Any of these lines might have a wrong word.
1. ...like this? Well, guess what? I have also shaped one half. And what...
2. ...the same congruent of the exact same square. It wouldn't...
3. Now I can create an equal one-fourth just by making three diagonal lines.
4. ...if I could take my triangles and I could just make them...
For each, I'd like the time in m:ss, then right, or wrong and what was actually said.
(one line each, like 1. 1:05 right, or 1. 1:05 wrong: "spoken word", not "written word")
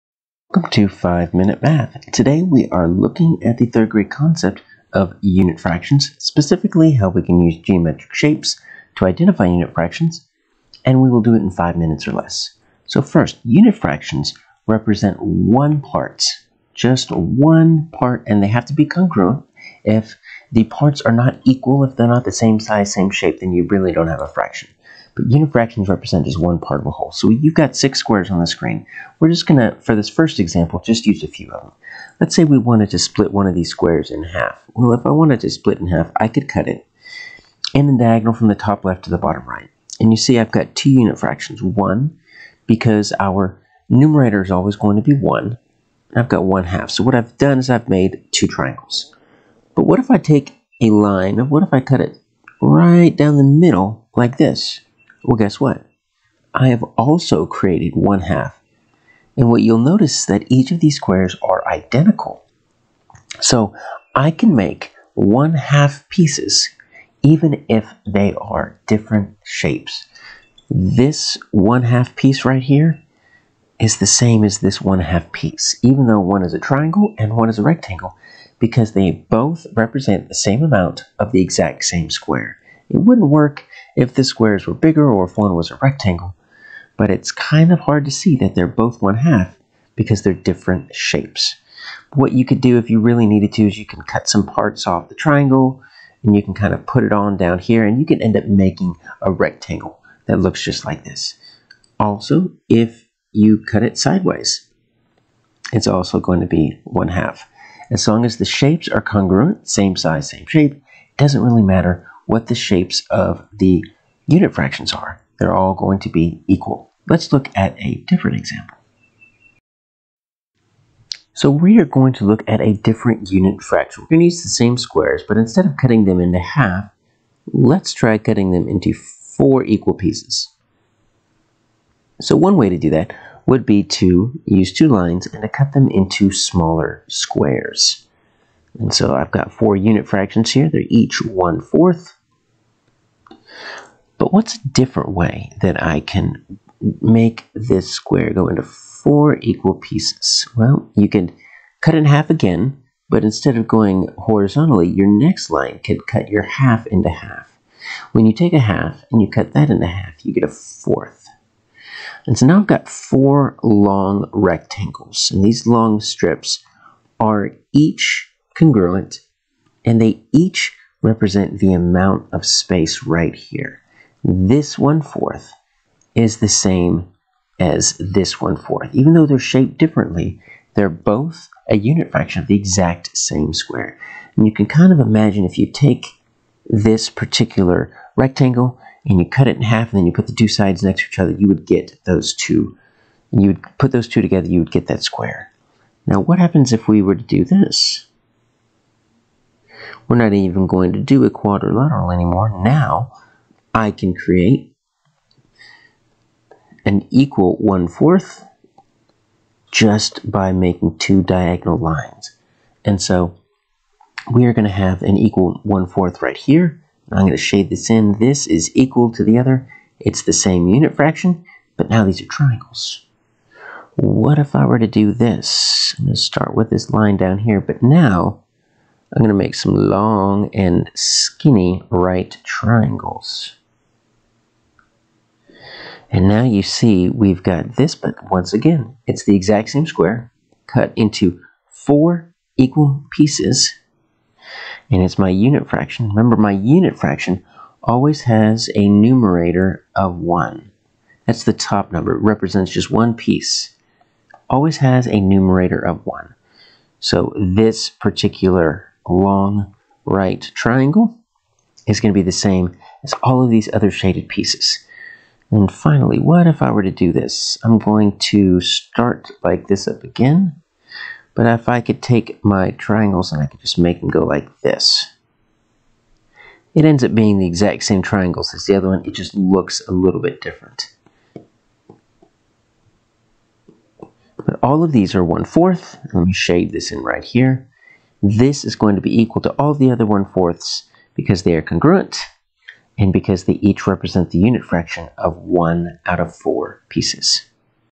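1. 0:54 wrong: "created", not "shaped"
2. 1:20 wrong: "amount", not "congruent"
3. 3:22 wrong: "two", not "three"
4. 4:31 right.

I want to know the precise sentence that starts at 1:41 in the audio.
Also, if you cut it sideways, it's also going to be one half.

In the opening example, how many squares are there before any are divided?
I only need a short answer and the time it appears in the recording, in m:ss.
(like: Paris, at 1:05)
6, at 0:27.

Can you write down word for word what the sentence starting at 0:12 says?
So first, unit fractions represent one part, just one part, and they have to be congruent.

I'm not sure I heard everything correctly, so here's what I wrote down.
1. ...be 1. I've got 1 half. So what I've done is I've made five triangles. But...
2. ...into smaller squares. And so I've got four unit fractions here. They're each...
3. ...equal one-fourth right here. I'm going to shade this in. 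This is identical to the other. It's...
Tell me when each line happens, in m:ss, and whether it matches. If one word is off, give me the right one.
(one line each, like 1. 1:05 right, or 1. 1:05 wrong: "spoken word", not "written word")
1. 0:45 wrong: "two", not "five"
2. 2:15 right
3. 3:35 wrong: "equal", not "identical".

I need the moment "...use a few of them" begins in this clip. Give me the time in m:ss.
0:31.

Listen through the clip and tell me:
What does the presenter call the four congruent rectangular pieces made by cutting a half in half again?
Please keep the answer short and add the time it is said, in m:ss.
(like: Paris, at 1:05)
long strips, at 2:45.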